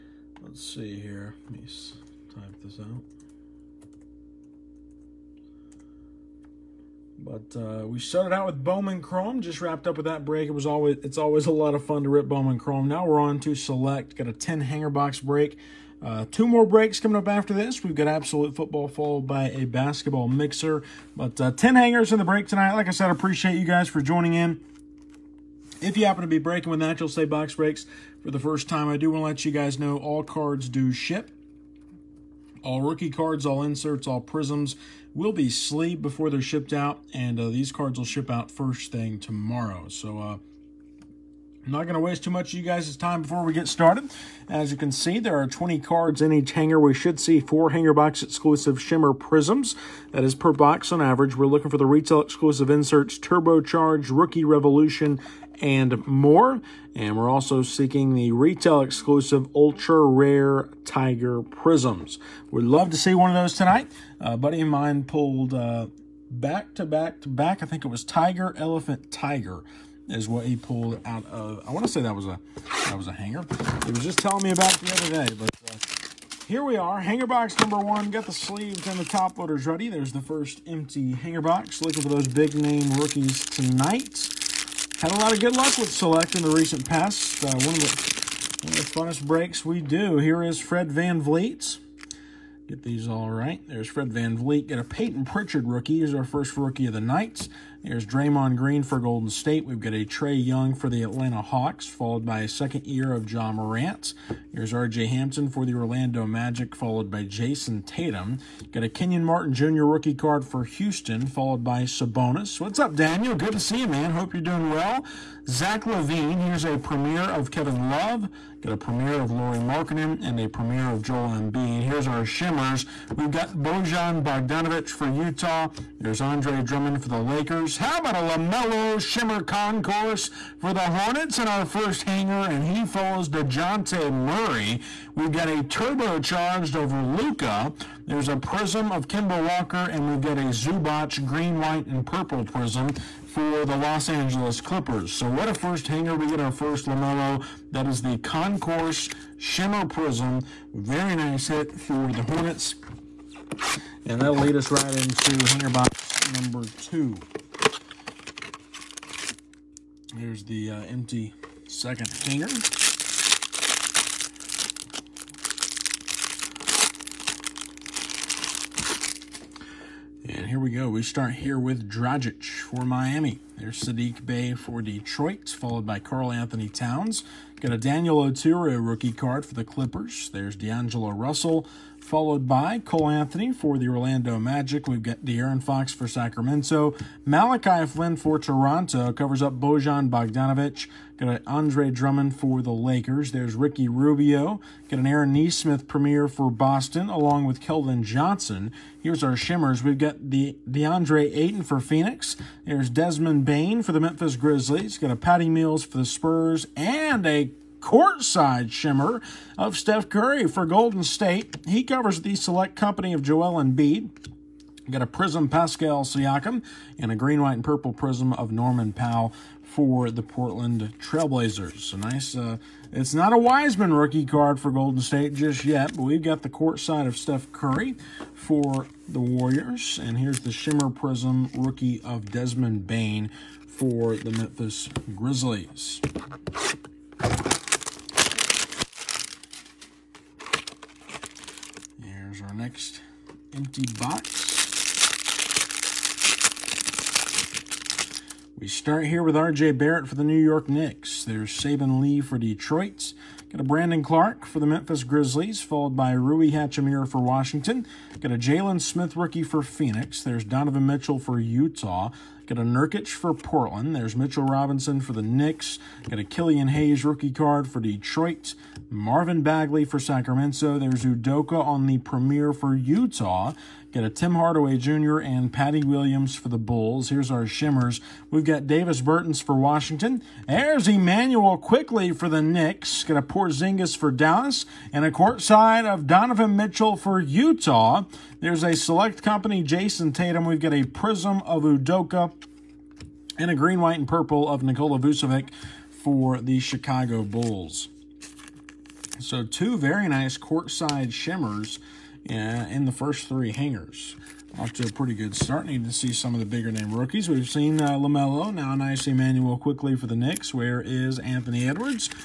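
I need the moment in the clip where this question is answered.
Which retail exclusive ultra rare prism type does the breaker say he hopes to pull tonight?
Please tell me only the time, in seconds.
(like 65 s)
60 s.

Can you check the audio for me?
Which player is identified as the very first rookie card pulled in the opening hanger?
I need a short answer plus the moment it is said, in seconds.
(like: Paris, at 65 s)
Peyton Pritchard, at 94 s.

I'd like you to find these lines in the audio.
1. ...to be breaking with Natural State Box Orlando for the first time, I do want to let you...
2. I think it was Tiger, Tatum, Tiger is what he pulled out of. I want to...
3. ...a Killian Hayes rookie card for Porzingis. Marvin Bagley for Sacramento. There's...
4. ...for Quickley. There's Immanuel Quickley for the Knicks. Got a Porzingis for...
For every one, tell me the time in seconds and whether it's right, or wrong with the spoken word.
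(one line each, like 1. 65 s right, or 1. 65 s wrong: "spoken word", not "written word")
1. 26 s wrong: "Breaks", not "Orlando"
2. 67 s wrong: "Elephant", not "Tatum"
3. 266 s wrong: "Detroit", not "Porzingis"
4. 279 s wrong: "Washington", not "Quickley".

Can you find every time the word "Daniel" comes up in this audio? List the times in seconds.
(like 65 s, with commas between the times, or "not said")
112 s, 177 s.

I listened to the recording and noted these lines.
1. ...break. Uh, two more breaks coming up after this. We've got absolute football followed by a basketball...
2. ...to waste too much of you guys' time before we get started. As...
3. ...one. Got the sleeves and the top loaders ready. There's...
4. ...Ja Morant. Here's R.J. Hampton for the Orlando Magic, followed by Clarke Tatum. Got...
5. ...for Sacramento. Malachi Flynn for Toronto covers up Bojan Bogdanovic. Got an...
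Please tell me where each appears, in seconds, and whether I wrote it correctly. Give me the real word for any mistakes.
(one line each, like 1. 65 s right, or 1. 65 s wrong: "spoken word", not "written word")
1. 15 s right
2. 41 s right
3. 77 s right
4. 103 s wrong: "Jayson", not "Clarke"
5. 185 s right.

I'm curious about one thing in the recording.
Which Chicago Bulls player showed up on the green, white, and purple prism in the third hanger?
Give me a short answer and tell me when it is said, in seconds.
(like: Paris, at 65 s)
Nikola Vucevic, at 294 s.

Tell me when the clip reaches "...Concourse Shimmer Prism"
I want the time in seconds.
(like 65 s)
148 s.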